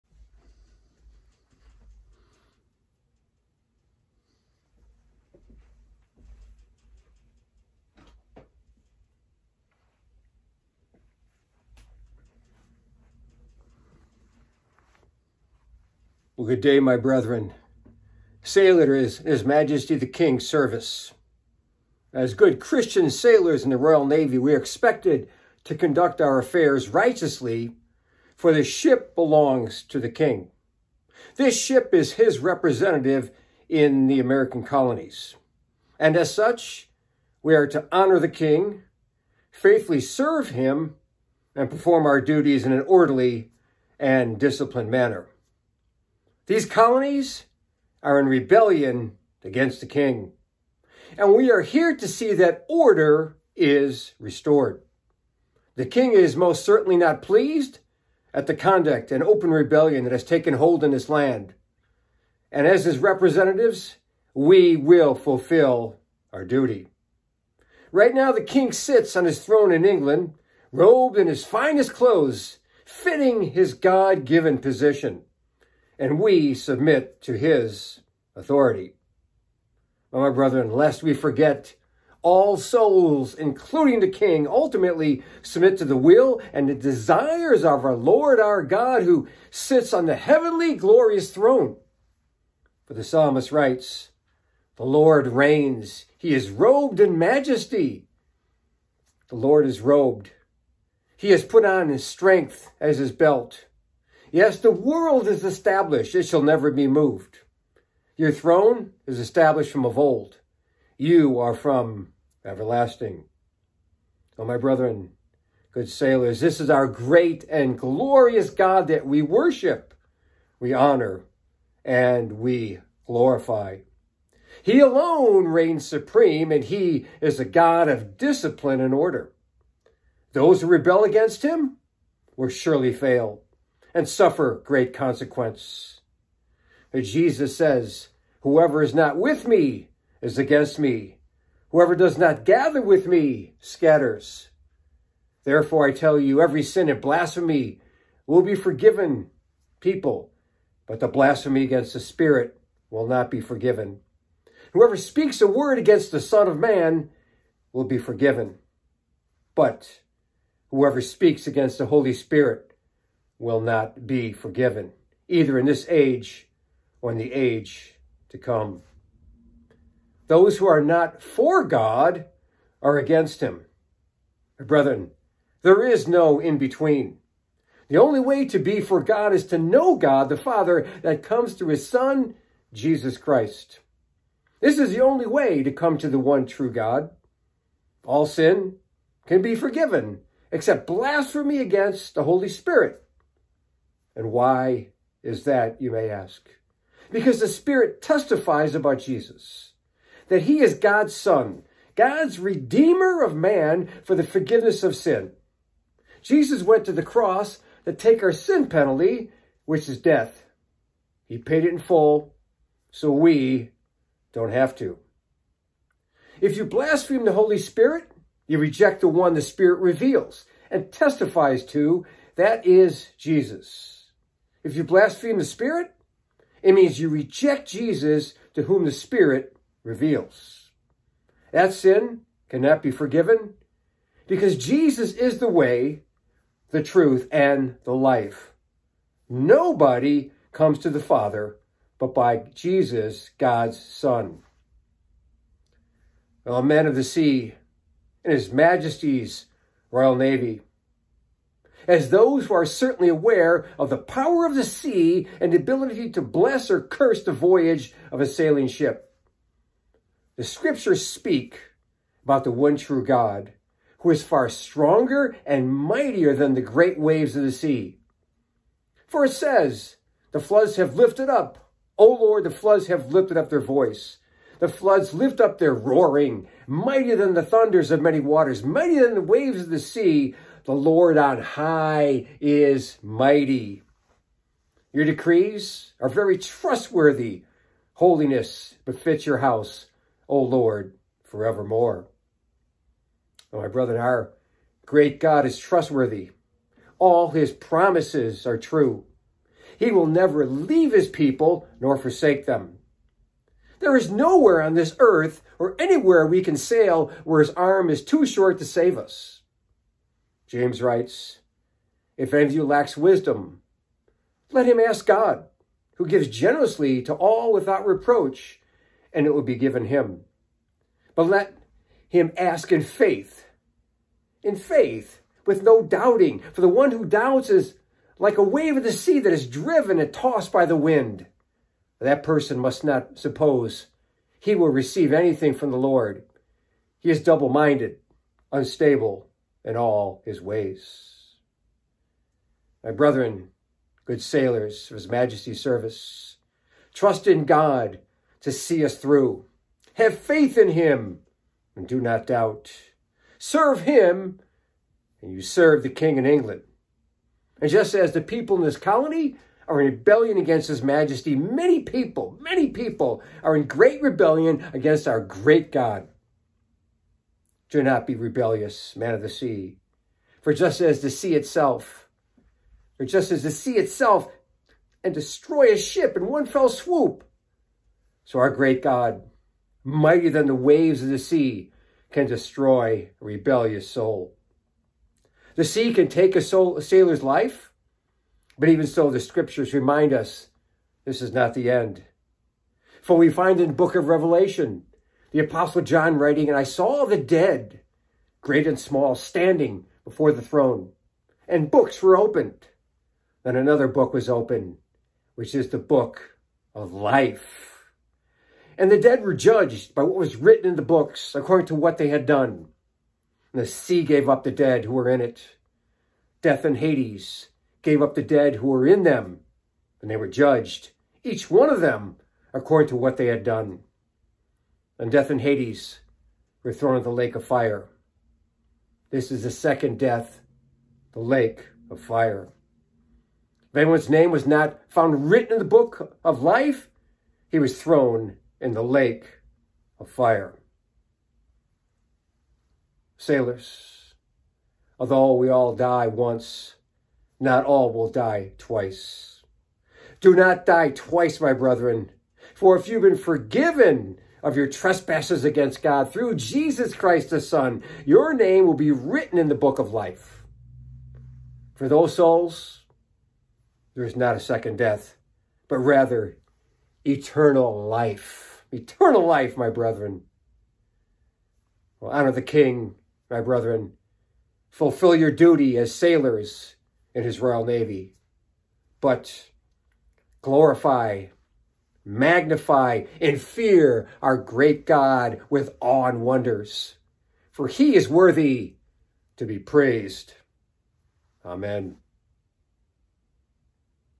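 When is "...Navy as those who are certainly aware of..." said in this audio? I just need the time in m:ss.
4:10.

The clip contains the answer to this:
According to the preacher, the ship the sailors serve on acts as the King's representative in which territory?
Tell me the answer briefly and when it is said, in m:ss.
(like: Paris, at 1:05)
American colonies, at 0:34.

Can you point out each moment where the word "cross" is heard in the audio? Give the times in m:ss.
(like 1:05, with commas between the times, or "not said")
3:27.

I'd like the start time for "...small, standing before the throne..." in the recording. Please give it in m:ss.
6:38.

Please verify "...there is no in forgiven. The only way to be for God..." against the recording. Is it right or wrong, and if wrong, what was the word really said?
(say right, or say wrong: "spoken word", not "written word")
wrong: "between", not "forgiven".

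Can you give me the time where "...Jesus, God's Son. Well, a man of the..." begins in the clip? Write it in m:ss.
4:02.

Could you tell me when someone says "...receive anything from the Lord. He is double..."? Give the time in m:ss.
5:34.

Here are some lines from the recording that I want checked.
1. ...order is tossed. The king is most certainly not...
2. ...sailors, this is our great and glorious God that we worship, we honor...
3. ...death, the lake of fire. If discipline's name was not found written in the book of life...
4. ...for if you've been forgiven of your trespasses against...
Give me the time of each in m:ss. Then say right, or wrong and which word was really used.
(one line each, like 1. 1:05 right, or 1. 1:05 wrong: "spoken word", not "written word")
1. 0:52 wrong: "restored", not "tossed"
2. 1:55 right
3. 7:09 wrong: "anyone", not "discipline"
4. 7:32 right.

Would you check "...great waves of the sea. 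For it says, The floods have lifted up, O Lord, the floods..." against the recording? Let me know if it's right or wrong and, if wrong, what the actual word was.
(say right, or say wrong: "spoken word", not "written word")
right.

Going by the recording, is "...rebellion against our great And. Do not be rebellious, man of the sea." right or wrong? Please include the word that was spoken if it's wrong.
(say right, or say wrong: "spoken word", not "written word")
wrong: "God", not "And".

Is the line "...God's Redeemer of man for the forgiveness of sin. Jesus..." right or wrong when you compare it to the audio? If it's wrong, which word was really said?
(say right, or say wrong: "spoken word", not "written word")
right.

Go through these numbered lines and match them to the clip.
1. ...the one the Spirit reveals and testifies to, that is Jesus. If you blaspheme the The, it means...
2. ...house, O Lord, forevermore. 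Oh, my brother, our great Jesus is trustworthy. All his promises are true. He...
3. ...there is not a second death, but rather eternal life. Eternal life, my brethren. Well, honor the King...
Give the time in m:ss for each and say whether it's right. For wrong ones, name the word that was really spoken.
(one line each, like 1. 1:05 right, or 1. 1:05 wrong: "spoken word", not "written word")
1. 3:39 wrong: "Spirit", not "The"
2. 4:49 wrong: "God", not "Jesus"
3. 7:43 right.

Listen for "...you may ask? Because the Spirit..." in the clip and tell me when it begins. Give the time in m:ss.
3:15.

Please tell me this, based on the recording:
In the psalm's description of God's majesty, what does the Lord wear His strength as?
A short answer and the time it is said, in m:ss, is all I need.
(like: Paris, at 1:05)
His belt, at 1:43.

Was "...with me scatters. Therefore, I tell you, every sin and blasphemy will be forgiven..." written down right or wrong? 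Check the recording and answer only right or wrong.
right.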